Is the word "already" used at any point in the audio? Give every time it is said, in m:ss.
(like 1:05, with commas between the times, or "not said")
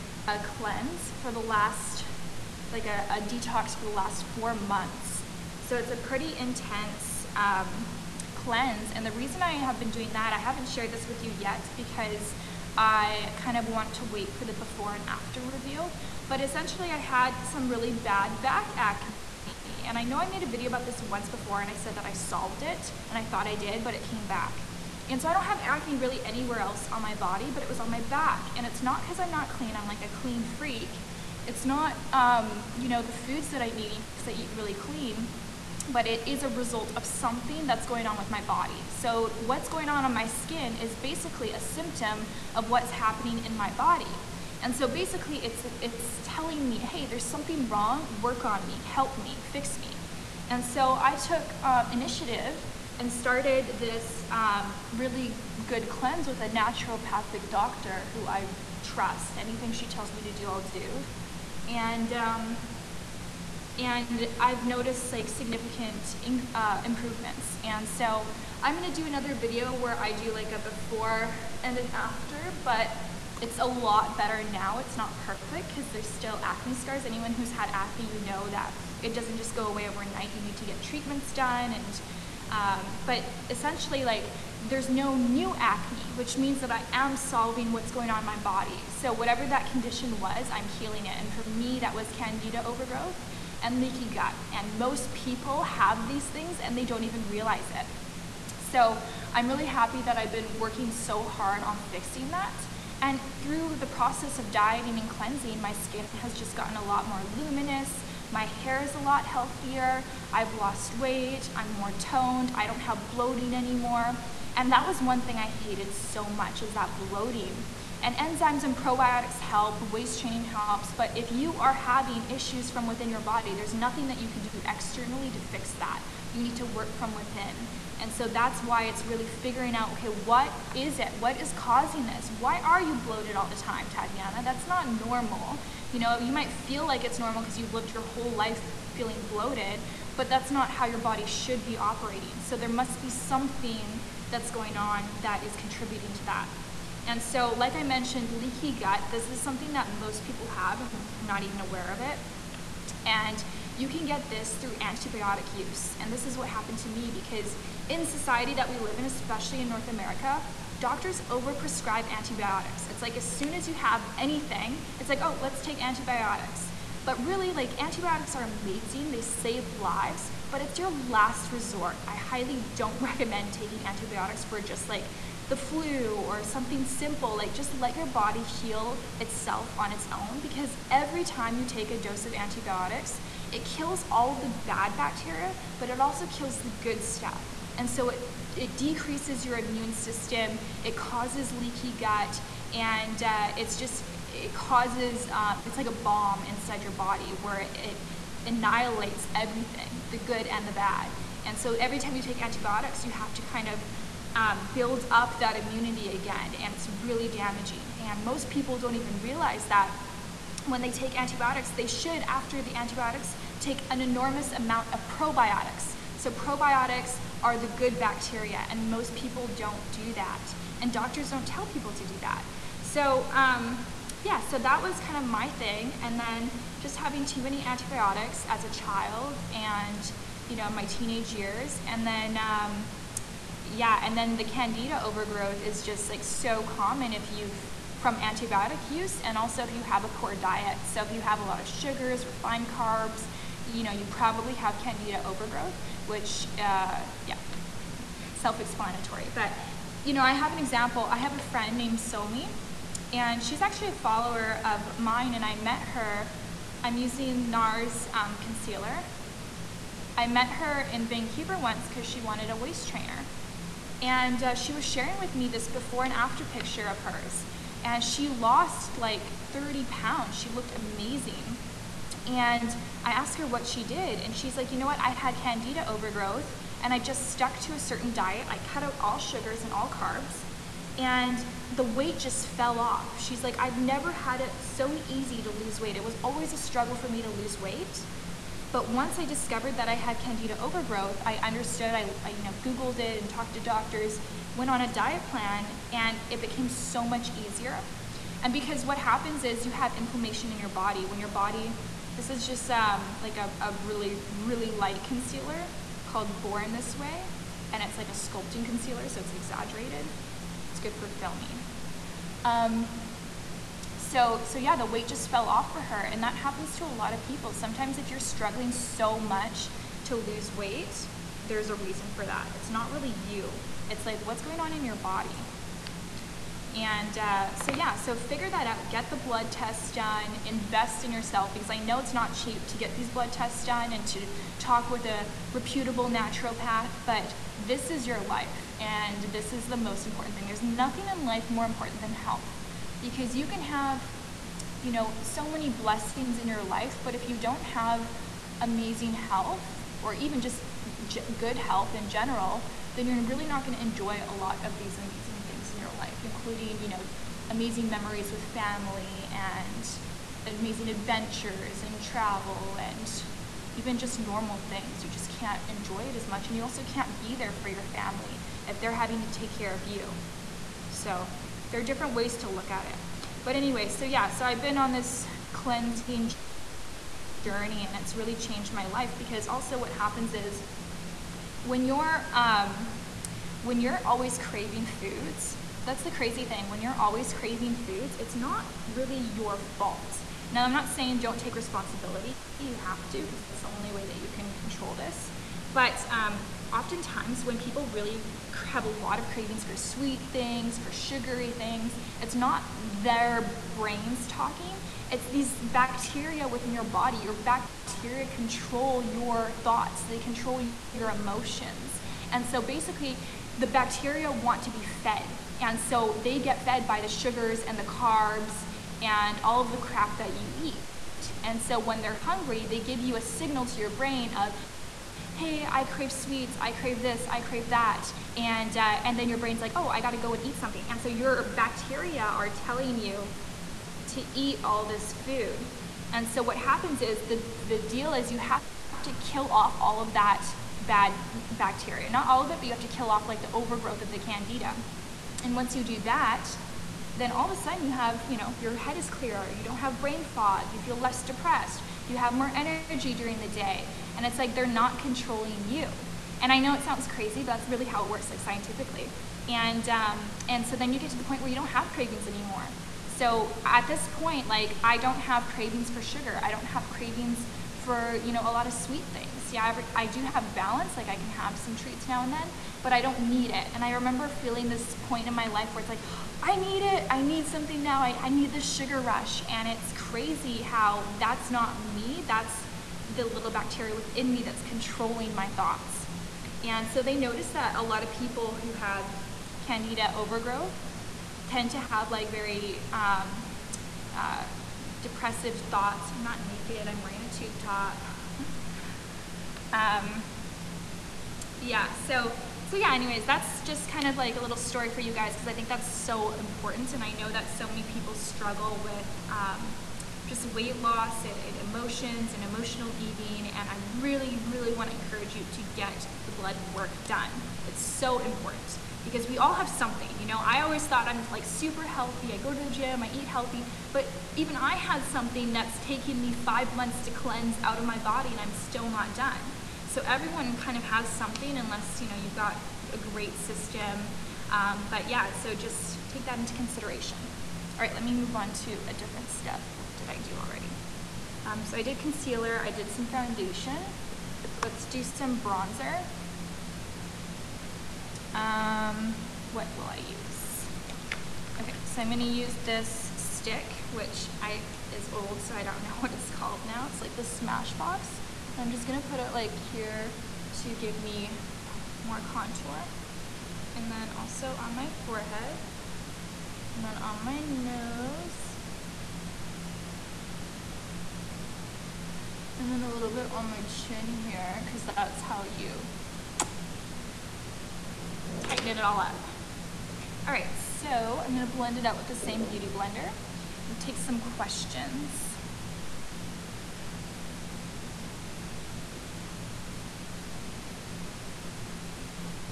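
9:00.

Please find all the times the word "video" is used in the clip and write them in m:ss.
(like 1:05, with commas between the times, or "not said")
0:20, 1:09.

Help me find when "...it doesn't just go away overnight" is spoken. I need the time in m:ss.
1:19.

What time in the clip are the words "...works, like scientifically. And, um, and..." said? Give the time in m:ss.
7:38.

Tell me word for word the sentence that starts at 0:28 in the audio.
And it's not because I'm not clean, I'm like a clean freak.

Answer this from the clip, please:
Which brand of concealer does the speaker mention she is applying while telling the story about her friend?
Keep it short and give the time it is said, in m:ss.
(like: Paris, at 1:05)
NARS, at 4:17.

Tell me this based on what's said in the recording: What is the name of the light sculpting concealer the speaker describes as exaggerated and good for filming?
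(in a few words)
Born This Way.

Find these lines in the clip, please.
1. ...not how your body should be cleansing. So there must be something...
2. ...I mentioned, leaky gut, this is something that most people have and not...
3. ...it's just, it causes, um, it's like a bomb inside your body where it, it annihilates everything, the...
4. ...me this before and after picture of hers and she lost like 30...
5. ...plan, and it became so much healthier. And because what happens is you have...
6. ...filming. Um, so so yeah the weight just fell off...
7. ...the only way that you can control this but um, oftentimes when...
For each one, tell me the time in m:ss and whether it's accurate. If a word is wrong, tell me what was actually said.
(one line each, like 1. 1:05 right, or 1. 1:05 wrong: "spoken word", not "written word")
1. 2:20 wrong: "operating", not "cleansing"
2. 2:27 right
3. 3:13 right
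4. 4:25 right
5. 4:55 wrong: "easier", not "healthier"
6. 5:11 right
7. 6:33 right.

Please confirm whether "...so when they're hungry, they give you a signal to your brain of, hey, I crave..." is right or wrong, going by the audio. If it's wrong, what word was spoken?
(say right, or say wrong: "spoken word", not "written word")
right.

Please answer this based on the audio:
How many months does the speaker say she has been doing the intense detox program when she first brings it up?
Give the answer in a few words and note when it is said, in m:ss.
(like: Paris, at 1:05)
4, at 0:04.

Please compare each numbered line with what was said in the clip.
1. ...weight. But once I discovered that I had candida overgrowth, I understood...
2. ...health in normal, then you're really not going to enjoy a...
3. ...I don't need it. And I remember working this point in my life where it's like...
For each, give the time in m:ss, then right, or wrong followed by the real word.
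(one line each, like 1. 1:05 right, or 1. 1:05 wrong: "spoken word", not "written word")
1. 4:47 right
2. 5:51 wrong: "general", not "normal"
3. 7:52 wrong: "feeling", not "working".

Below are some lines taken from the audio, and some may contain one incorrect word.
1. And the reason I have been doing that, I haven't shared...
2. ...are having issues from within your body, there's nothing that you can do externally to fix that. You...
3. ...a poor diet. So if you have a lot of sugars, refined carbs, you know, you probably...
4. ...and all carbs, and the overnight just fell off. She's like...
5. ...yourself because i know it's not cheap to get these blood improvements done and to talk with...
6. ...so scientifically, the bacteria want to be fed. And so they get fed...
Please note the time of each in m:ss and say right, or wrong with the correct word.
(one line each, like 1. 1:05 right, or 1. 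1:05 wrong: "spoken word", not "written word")
1. 0:08 right
2. 2:01 right
3. 4:00 right
4. 4:39 wrong: "weight", not "overnight"
5. 5:31 wrong: "tests", not "improvements"
6. 6:52 wrong: "basically", not "scientifically".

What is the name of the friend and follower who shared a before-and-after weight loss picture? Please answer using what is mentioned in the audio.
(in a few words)
Somi.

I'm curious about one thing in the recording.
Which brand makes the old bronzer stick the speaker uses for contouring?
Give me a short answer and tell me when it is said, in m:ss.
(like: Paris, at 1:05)
Smashbox, at 9:17.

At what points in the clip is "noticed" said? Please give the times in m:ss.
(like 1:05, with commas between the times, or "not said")
1:04, 8:07.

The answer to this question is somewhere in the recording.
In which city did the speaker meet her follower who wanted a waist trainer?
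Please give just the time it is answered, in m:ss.
4:21.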